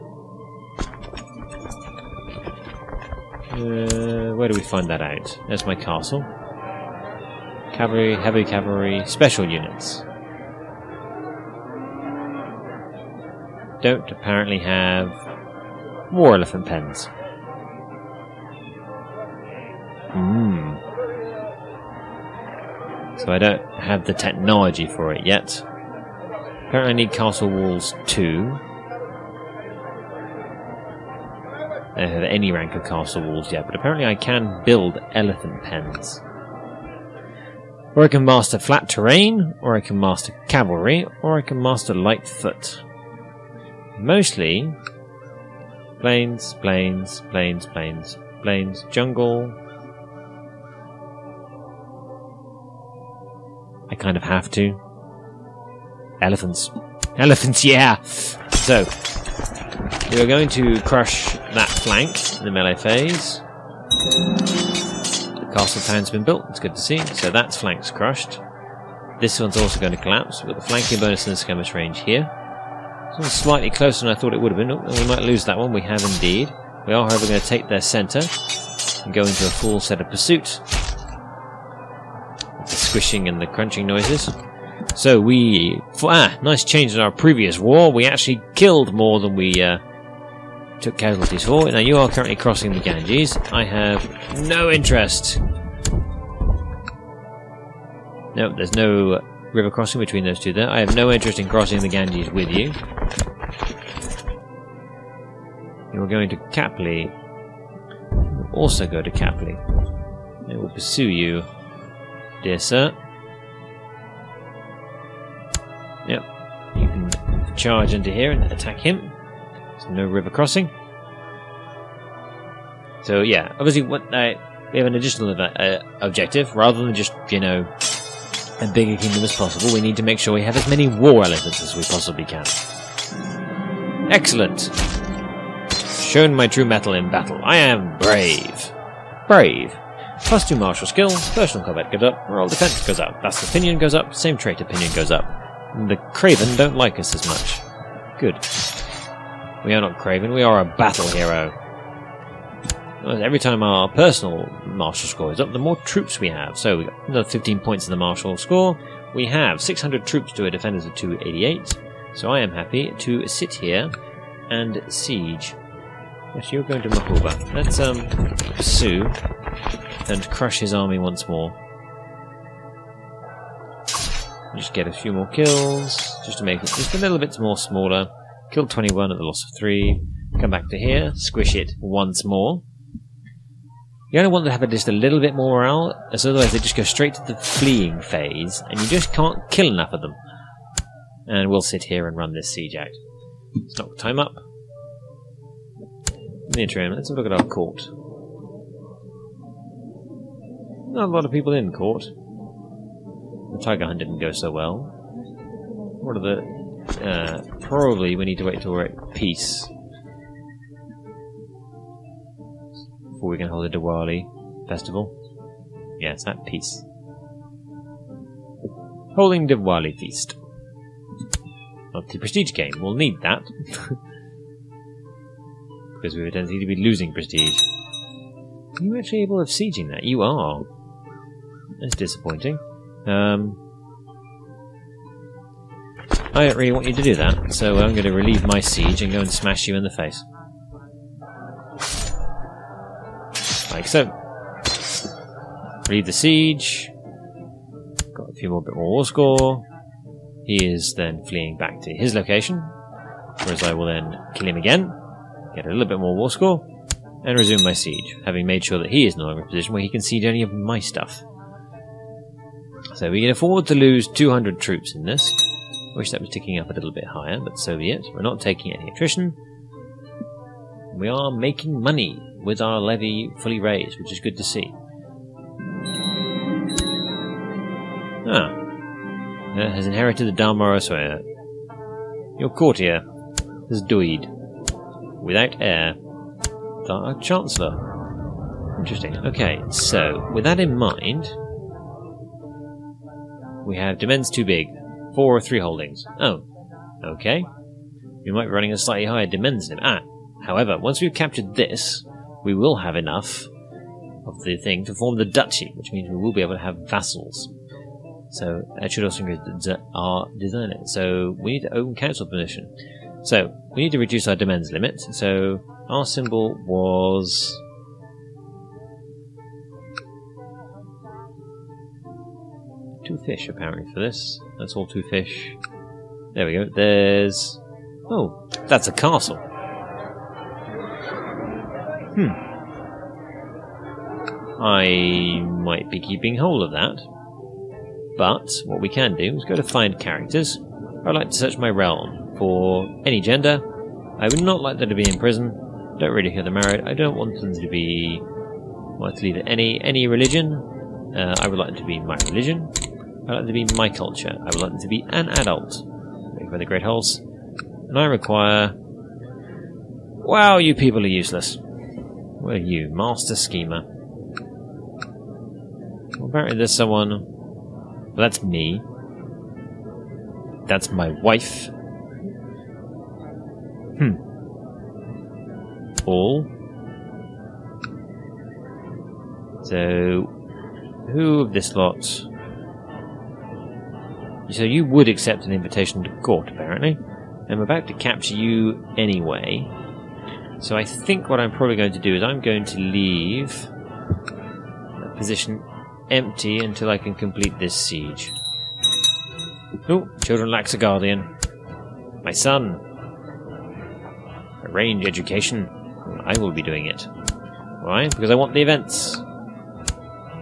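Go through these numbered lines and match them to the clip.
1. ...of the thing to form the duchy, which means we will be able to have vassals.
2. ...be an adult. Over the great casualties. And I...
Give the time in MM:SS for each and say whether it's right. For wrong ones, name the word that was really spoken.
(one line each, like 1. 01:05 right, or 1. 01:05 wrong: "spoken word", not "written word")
1. 05:04 right
2. 05:54 wrong: "holes", not "casualties".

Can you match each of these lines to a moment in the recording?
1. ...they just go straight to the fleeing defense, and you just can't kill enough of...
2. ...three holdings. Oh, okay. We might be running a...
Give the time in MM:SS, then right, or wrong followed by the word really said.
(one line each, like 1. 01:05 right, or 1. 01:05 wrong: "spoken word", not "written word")
1. 03:06 wrong: "phase", not "defense"
2. 04:55 right.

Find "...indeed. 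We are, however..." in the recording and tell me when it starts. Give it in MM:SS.
01:16.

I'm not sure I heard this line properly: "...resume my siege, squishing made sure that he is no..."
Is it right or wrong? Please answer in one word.
wrong.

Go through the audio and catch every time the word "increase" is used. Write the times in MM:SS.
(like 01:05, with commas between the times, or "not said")
05:09.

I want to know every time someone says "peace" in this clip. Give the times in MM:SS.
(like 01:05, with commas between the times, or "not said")
03:29, 03:36.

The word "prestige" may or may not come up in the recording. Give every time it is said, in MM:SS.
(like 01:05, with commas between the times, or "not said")
03:42, 03:47.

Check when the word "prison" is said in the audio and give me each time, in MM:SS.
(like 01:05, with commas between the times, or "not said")
05:45.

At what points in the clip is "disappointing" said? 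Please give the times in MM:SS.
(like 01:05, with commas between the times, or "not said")
03:51.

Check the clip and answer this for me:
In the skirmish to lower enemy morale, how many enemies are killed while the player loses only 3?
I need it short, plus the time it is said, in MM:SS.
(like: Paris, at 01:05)
21, at 02:58.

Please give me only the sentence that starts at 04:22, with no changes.
So we can afford to lose 200 troops in this.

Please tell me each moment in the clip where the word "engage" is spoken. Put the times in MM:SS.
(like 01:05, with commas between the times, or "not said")
not said.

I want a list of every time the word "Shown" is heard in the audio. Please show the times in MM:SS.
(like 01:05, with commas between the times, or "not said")
02:16.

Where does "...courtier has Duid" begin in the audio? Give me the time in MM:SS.
04:42.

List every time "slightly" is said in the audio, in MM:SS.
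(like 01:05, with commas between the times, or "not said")
01:13, 04:58.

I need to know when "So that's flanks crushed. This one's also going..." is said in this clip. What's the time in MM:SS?
01:06.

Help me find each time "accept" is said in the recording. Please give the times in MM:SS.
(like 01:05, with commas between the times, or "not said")
06:25.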